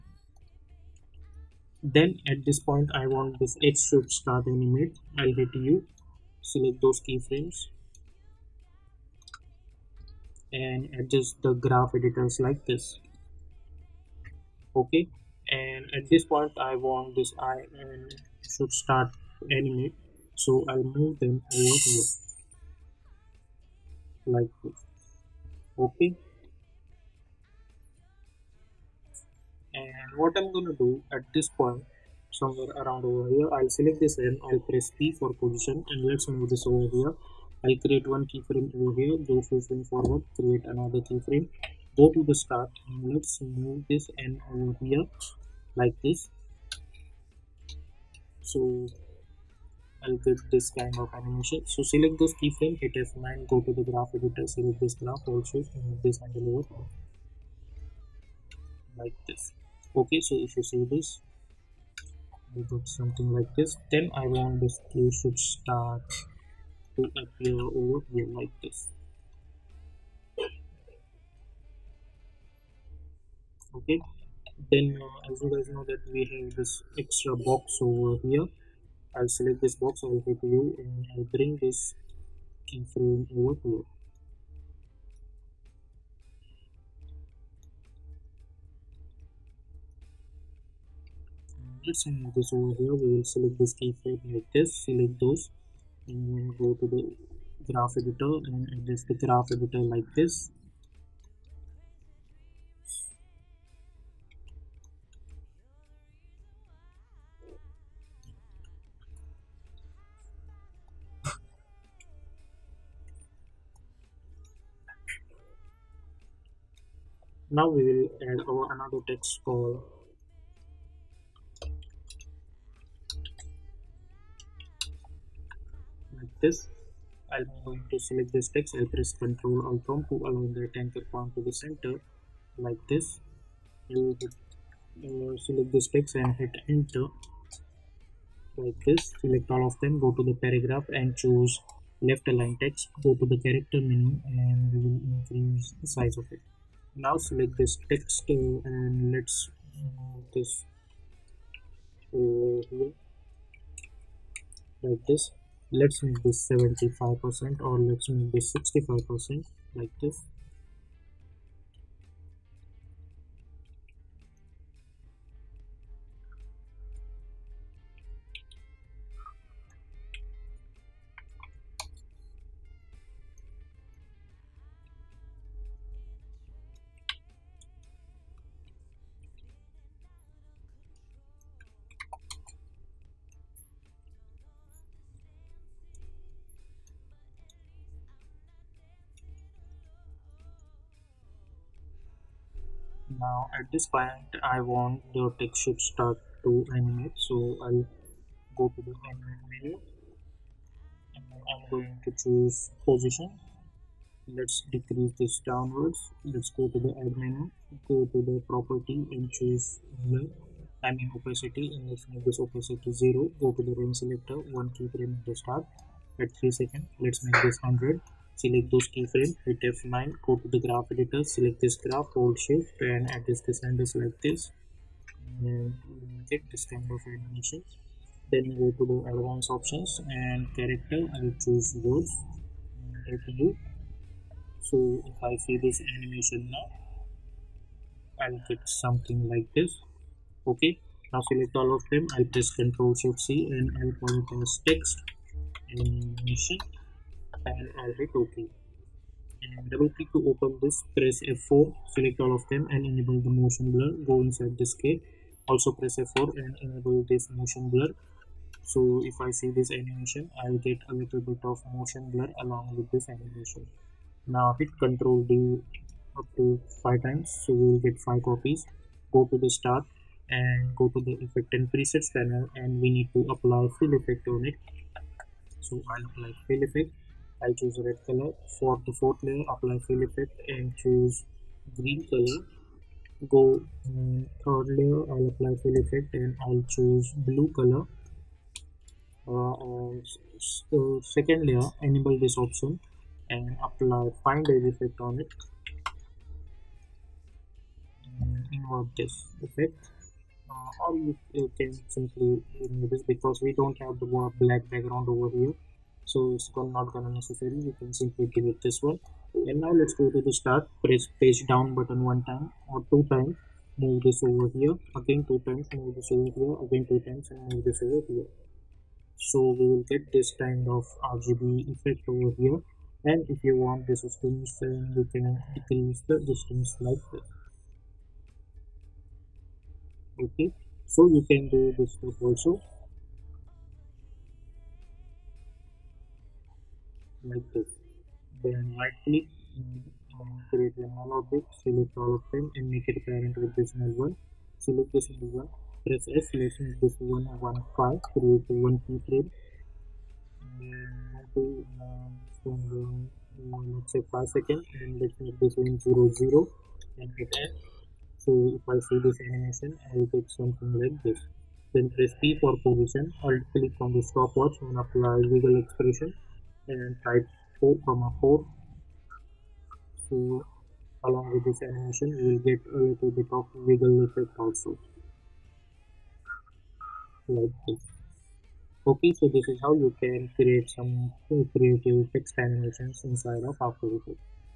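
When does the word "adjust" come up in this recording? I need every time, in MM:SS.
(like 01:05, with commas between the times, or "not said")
00:10, 01:38, 03:43.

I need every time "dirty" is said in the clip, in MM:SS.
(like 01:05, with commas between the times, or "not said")
not said.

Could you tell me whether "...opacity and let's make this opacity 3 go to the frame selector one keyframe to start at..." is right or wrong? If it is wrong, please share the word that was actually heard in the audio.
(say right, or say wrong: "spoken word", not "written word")
wrong: "0", not "3".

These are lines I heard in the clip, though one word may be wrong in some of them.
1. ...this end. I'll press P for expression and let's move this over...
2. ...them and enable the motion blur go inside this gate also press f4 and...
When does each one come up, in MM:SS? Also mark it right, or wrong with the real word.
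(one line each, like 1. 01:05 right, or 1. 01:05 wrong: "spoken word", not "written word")
1. 00:33 wrong: "position", not "expression"
2. 04:12 right.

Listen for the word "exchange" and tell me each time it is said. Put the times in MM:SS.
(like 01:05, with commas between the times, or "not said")
not said.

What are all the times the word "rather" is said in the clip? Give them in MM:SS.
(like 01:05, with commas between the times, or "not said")
not said.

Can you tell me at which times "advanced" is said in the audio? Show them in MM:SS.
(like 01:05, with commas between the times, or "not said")
03:49.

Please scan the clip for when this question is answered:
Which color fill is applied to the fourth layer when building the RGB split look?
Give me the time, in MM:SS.
04:37.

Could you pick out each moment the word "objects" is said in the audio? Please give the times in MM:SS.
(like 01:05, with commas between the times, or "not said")
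01:31, 05:41.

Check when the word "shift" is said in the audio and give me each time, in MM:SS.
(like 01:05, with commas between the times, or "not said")
03:42, 04:03.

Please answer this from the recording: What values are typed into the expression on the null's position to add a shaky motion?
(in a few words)
4,4.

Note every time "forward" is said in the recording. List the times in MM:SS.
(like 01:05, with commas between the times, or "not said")
00:39.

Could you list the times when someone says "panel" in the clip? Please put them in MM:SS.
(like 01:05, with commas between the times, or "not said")
04:07, 04:32.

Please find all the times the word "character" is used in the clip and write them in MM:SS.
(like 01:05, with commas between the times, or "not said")
02:23, 03:50.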